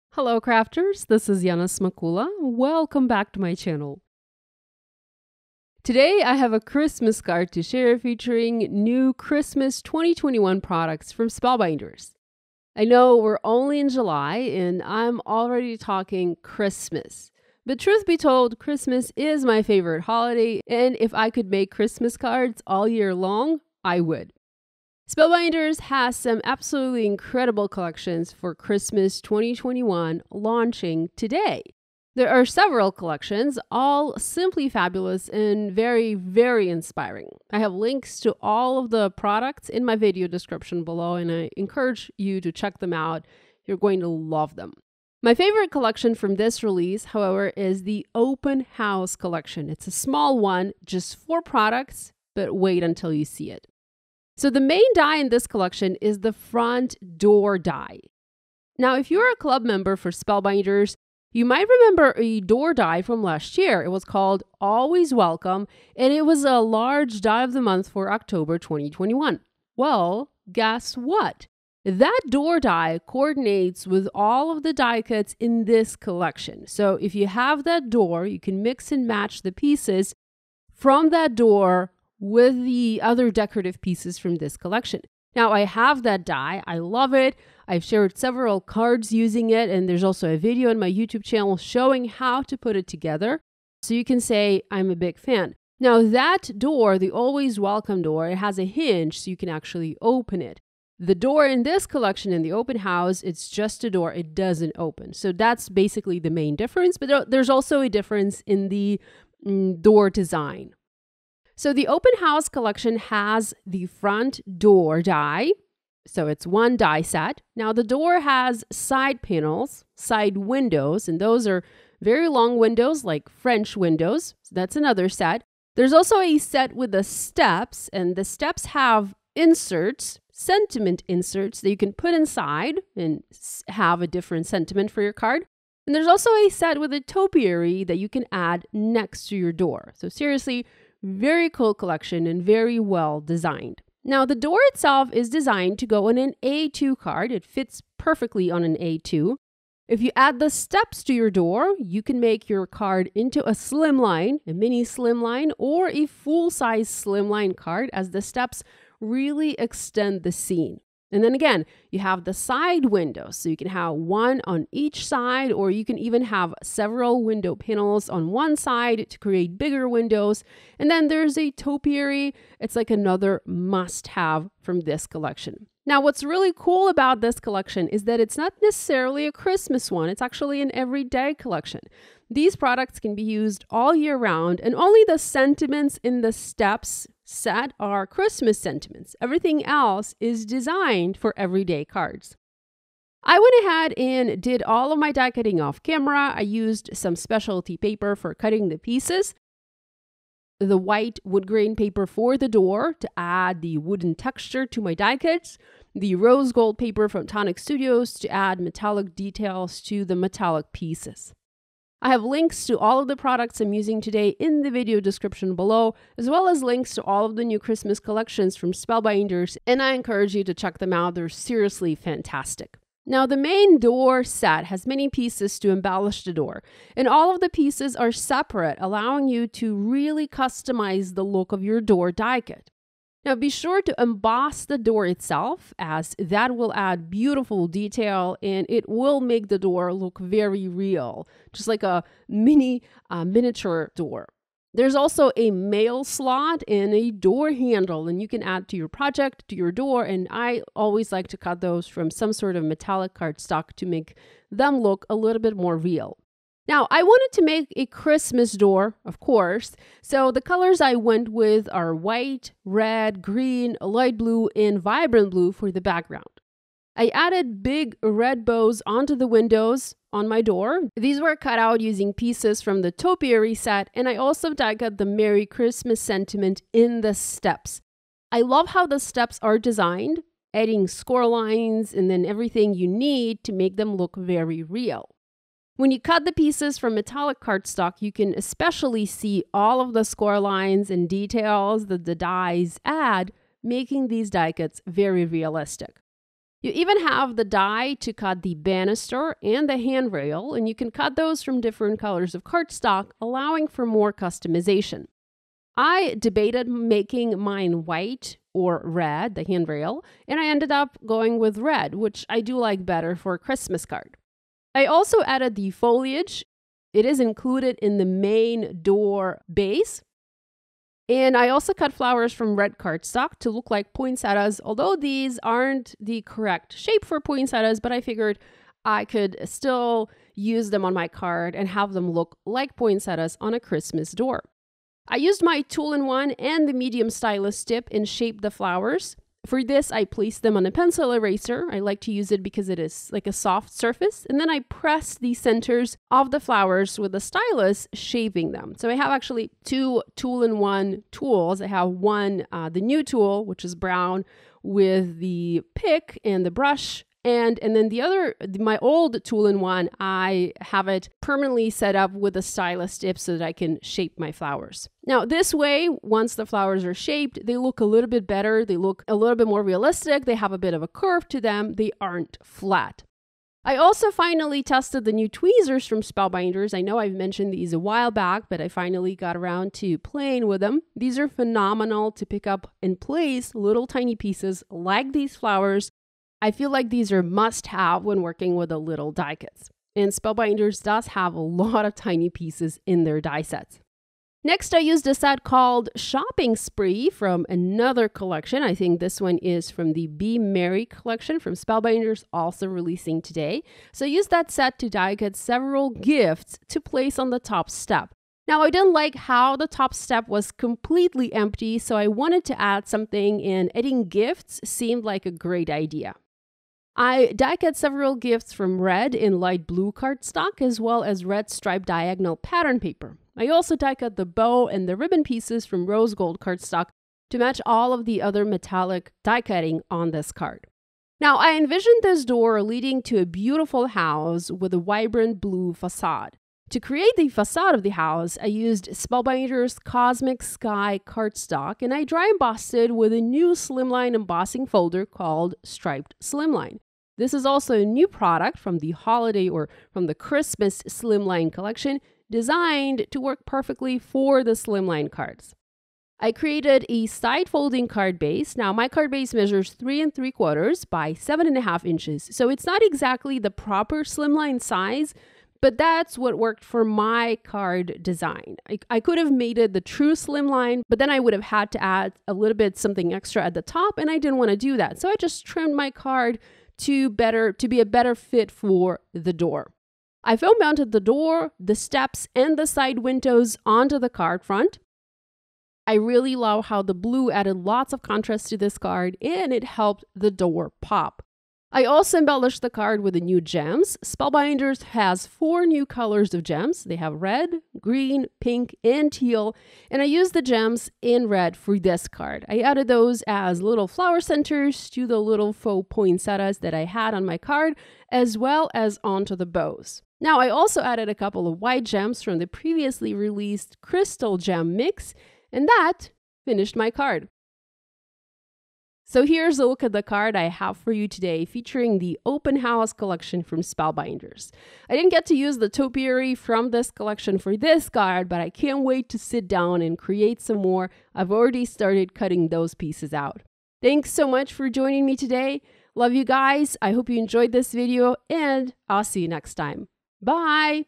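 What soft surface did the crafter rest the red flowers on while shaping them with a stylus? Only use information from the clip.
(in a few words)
pencil eraser.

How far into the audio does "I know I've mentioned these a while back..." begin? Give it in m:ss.
6:16.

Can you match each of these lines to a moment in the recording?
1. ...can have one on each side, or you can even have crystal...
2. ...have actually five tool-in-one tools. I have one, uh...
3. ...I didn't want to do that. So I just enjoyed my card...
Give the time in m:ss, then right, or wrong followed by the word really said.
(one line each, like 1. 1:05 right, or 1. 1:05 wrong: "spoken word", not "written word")
1. 2:43 wrong: "several", not "crystal"
2. 5:48 wrong: "two", not "five"
3. 7:54 wrong: "trimmed", not "enjoyed".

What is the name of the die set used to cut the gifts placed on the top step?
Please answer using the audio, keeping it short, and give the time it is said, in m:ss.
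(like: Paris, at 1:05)
Shopping Spree, at 6:35.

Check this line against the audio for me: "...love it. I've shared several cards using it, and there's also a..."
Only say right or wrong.
right.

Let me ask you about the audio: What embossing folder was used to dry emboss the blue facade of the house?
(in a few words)
Striped Slimline.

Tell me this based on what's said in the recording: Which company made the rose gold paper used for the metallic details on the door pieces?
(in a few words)
Tonic Studios.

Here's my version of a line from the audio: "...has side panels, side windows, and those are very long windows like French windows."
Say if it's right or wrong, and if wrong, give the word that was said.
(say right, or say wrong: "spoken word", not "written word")
right.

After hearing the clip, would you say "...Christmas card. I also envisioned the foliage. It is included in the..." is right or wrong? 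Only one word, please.
wrong.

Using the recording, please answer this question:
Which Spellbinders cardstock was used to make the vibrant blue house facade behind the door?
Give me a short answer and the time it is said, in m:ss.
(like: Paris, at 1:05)
Cosmic Sky, at 7:19.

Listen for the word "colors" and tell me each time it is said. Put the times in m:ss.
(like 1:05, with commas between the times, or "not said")
4:20, 5:01, 8:15.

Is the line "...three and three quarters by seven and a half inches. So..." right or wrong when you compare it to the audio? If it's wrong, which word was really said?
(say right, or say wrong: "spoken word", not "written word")
right.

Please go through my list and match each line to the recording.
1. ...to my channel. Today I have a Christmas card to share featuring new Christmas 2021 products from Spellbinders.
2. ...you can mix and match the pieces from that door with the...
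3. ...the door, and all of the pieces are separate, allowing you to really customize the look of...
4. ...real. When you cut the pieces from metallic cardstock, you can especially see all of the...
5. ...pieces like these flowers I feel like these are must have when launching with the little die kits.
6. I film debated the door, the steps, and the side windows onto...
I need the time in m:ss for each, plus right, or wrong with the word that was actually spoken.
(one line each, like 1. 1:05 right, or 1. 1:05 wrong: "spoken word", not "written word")
1. 0:03 right
2. 1:18 right
3. 3:46 right
4. 4:44 right
5. 6:24 wrong: "working", not "launching"
6. 8:00 wrong: "mounted", not "debated".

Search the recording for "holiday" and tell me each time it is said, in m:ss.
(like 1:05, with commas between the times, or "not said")
0:20, 7:28.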